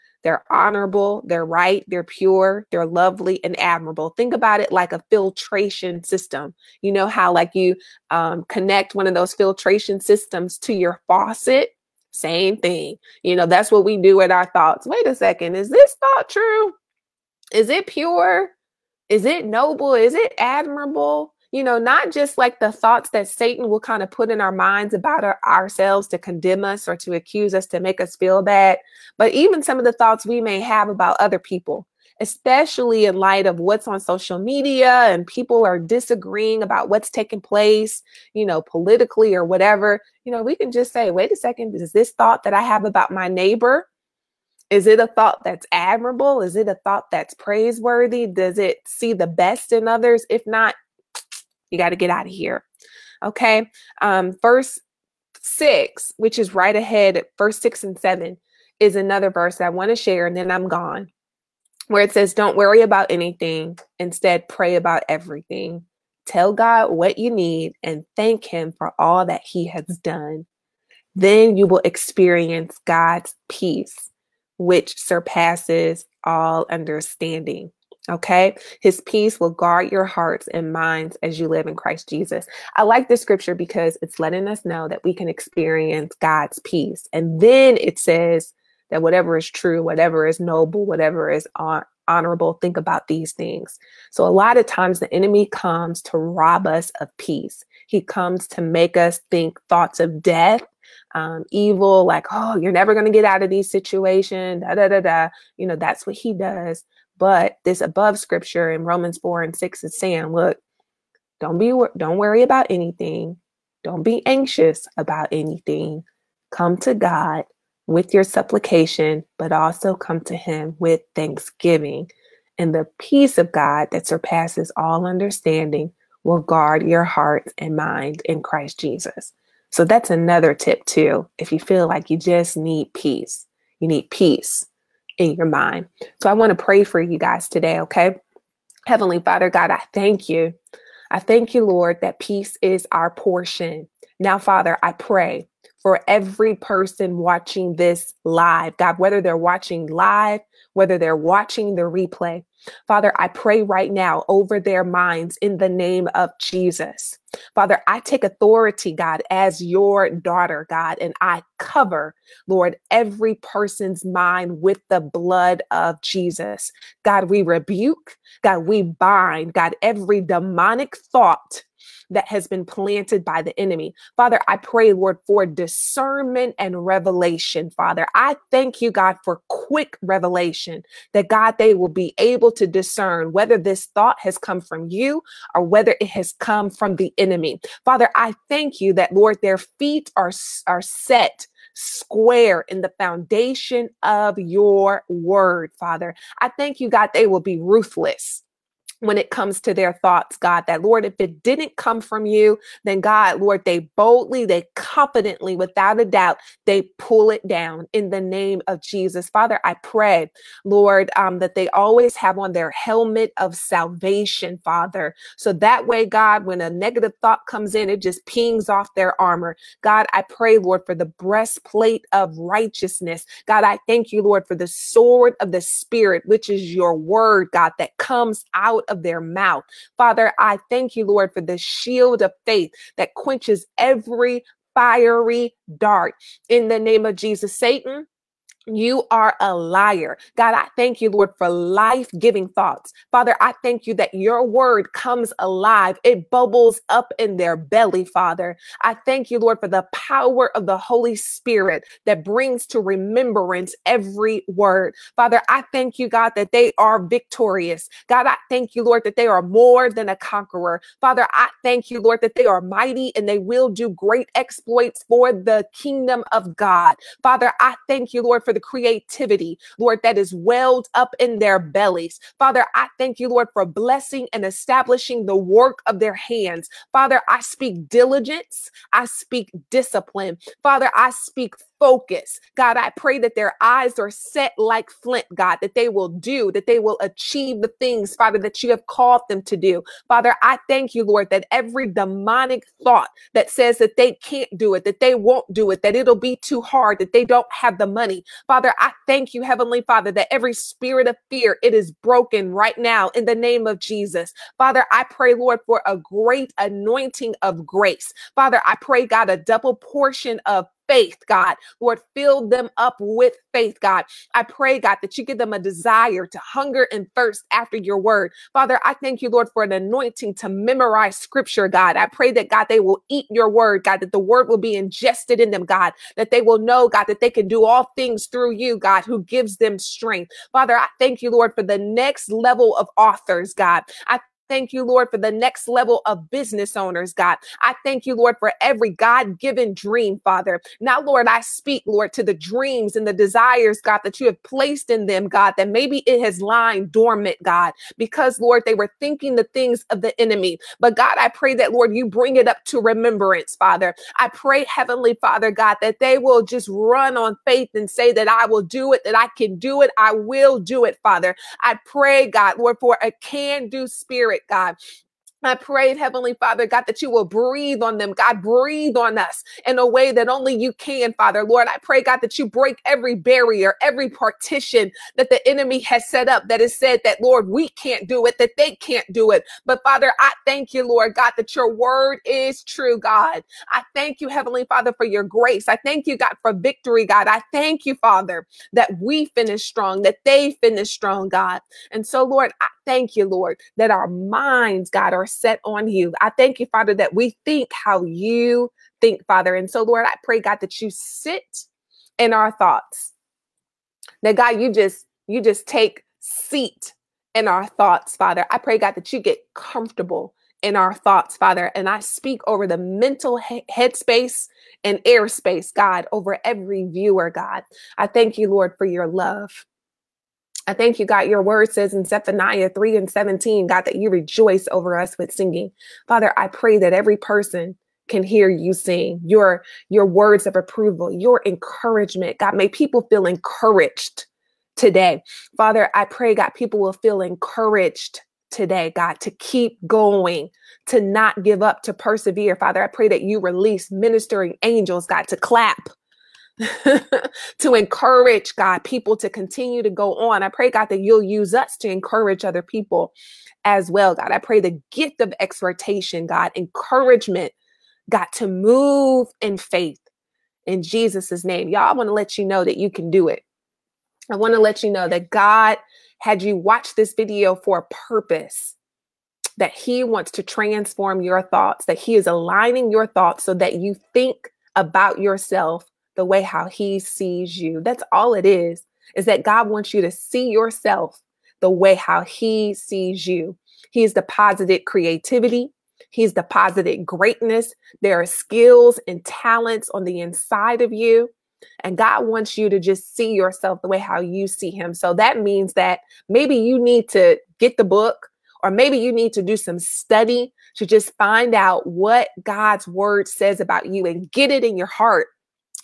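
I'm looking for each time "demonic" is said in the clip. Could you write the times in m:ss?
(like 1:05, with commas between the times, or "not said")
2:50, 4:51.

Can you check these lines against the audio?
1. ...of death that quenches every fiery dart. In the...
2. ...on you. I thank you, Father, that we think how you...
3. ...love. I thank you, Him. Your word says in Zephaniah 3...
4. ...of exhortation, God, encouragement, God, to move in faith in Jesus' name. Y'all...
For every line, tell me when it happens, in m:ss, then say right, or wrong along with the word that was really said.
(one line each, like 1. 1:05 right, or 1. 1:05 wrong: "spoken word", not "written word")
1. 3:52 wrong: "faith", not "death"
2. 6:35 right
3. 6:59 wrong: "God", not "Him"
4. 7:35 right.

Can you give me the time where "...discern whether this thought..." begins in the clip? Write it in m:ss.
3:02.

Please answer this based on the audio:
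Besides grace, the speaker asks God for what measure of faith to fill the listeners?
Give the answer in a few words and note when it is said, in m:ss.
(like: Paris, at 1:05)
double portion, at 5:09.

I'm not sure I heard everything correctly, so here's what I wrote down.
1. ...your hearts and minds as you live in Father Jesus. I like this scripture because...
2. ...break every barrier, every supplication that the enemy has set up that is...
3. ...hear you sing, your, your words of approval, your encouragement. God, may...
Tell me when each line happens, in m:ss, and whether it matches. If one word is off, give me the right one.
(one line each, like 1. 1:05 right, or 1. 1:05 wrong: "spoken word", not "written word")
1. 1:19 wrong: "Christ", not "Father"
2. 6:12 wrong: "partition", not "supplication"
3. 7:08 right.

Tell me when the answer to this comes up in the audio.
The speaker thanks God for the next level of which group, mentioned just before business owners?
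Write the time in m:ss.
5:32.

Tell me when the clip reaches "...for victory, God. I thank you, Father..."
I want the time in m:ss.
6:26.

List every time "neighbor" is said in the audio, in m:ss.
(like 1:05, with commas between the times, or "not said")
0:43.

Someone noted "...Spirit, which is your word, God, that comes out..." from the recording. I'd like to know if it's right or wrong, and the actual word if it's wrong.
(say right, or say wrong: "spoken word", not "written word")
right.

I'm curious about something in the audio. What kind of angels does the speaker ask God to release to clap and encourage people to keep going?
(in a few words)
ministering angels.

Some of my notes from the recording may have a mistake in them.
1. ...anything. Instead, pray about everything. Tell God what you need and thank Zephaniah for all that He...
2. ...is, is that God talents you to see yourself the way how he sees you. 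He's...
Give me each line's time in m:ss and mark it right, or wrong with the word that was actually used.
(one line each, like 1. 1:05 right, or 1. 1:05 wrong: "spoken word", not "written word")
1. 1:03 wrong: "Him", not "Zephaniah"
2. 7:58 wrong: "wants", not "talents".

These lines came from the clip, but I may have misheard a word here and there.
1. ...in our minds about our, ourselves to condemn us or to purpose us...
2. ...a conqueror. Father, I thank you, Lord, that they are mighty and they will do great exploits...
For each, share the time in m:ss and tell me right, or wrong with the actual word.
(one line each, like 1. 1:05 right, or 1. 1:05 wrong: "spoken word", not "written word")
1. 0:24 wrong: "accuse", not "purpose"
2. 4:20 right.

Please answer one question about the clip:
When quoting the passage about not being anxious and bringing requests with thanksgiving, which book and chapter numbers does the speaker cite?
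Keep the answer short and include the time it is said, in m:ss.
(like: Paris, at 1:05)
Romans 4 and 6, at 1:48.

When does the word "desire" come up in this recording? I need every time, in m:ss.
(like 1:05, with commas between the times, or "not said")
5:15, 5:43.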